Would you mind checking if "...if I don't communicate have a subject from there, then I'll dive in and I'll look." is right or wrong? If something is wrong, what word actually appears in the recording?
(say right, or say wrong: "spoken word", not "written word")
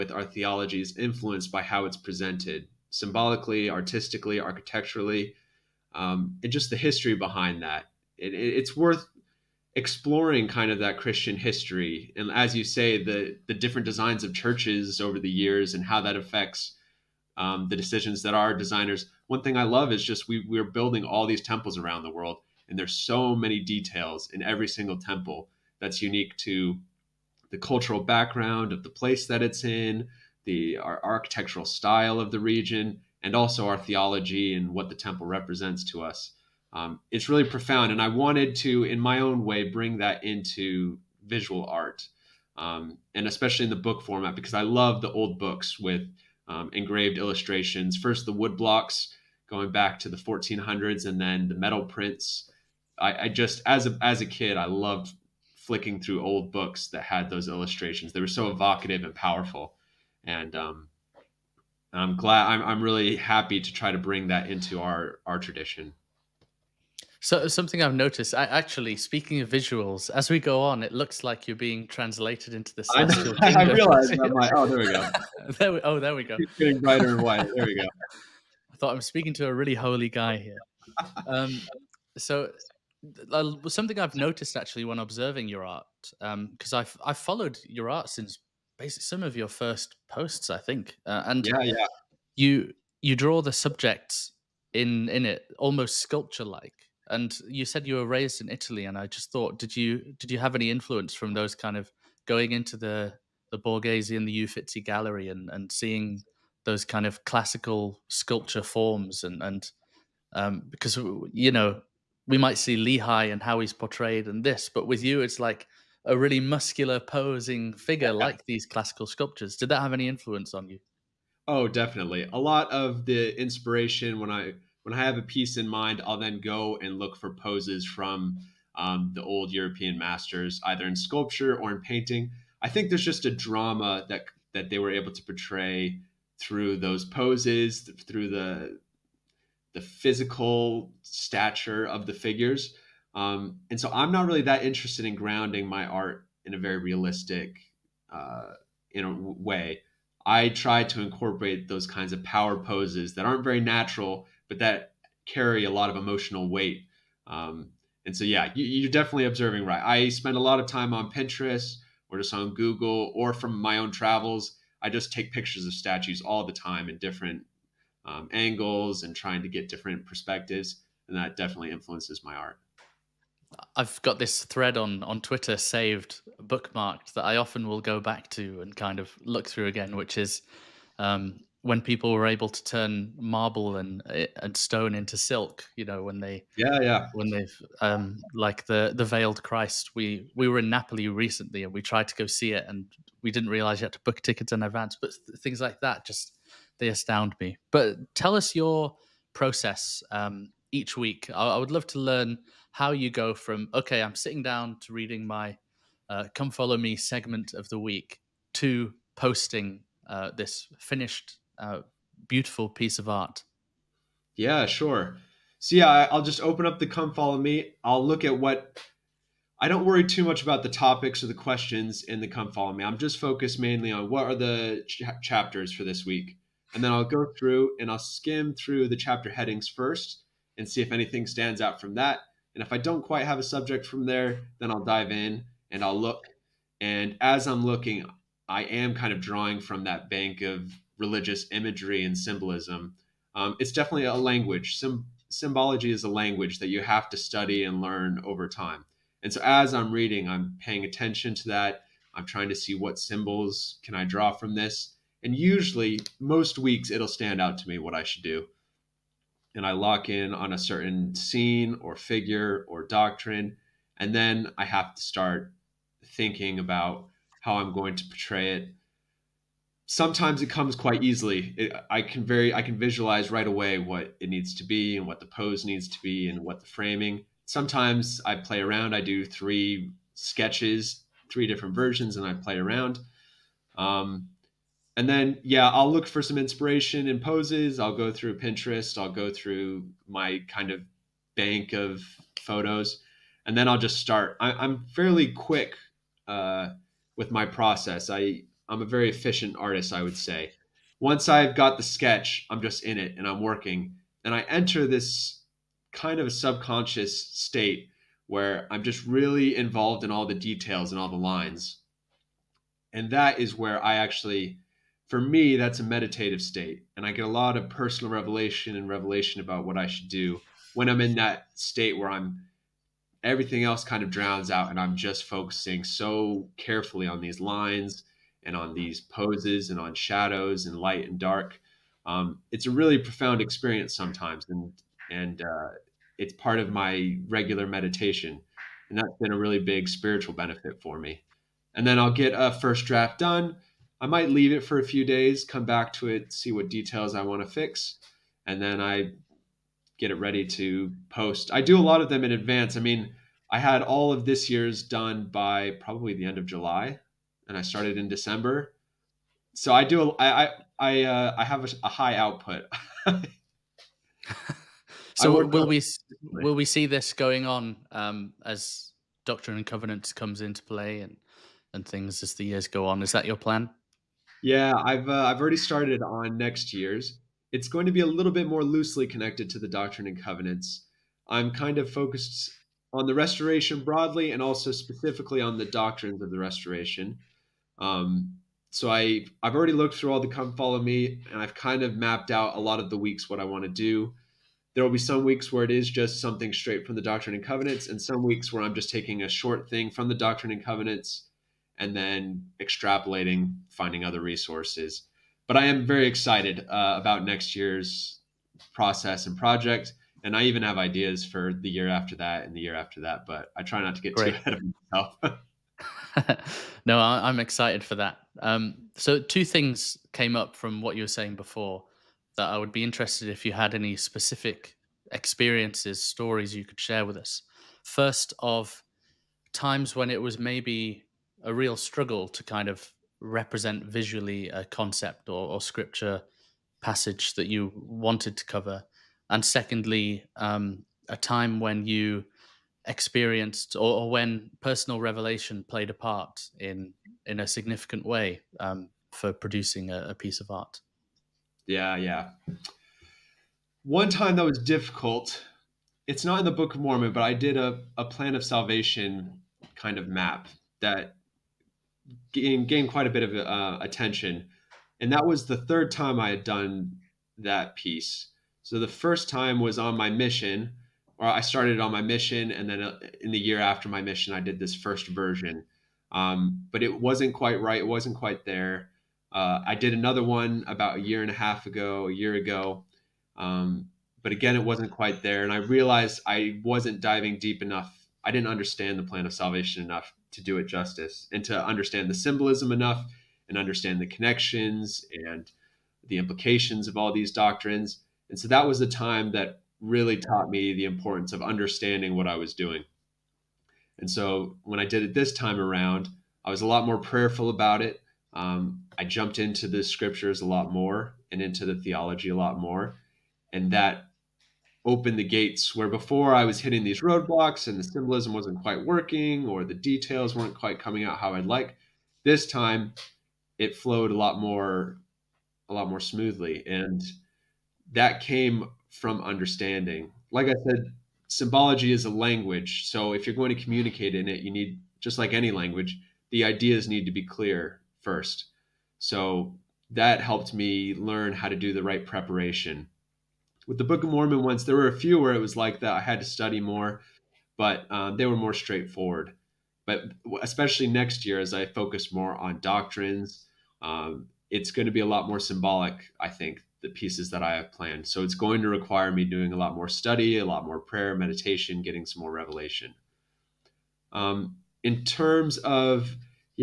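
wrong: "quite", not "communicate".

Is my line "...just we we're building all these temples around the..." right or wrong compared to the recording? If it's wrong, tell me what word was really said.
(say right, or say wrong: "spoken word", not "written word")
right.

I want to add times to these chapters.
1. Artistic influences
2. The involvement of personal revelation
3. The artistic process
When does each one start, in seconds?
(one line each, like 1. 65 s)
1. 82 s
2. 429 s
3. 202 s.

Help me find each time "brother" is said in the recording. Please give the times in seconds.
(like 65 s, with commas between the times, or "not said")
not said.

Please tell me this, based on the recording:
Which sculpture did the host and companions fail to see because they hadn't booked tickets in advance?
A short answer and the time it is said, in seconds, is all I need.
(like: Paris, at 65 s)
The Veiled Christ, at 188 s.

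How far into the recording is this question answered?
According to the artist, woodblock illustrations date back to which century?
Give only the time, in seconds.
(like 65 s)
50 s.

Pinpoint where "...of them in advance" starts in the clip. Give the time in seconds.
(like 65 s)
352 s.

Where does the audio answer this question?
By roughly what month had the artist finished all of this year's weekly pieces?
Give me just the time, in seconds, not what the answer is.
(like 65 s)
356 s.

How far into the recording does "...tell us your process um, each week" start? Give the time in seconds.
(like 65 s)
198 s.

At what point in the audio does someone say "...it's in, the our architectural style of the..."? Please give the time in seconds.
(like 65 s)
29 s.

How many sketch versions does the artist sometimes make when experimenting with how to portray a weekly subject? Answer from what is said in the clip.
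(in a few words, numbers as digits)
3.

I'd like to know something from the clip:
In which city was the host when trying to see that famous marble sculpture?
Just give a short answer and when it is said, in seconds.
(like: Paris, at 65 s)
Napoli, at 190 s.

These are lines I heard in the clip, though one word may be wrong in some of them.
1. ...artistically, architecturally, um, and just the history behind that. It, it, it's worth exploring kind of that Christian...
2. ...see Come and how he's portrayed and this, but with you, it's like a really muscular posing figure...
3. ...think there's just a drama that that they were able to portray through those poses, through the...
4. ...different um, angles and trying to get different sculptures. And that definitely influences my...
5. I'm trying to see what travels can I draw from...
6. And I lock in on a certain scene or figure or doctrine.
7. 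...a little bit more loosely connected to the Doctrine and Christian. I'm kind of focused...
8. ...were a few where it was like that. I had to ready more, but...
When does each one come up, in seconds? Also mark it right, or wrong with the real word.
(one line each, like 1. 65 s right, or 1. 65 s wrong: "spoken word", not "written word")
1. 3 s right
2. 112 s wrong: "Lehi", not "Come"
3. 132 s right
4. 166 s wrong: "perspectives", not "sculptures"
5. 252 s wrong: "symbols", not "travels"
6. 259 s right
7. 377 s wrong: "Covenants", not "Christian"
8. 544 s wrong: "study", not "ready".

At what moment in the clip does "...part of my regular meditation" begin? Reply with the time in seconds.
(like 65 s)
336 s.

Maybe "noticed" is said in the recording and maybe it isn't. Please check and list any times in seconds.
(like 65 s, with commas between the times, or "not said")
67 s, 84 s.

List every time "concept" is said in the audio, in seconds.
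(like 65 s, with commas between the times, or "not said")
434 s.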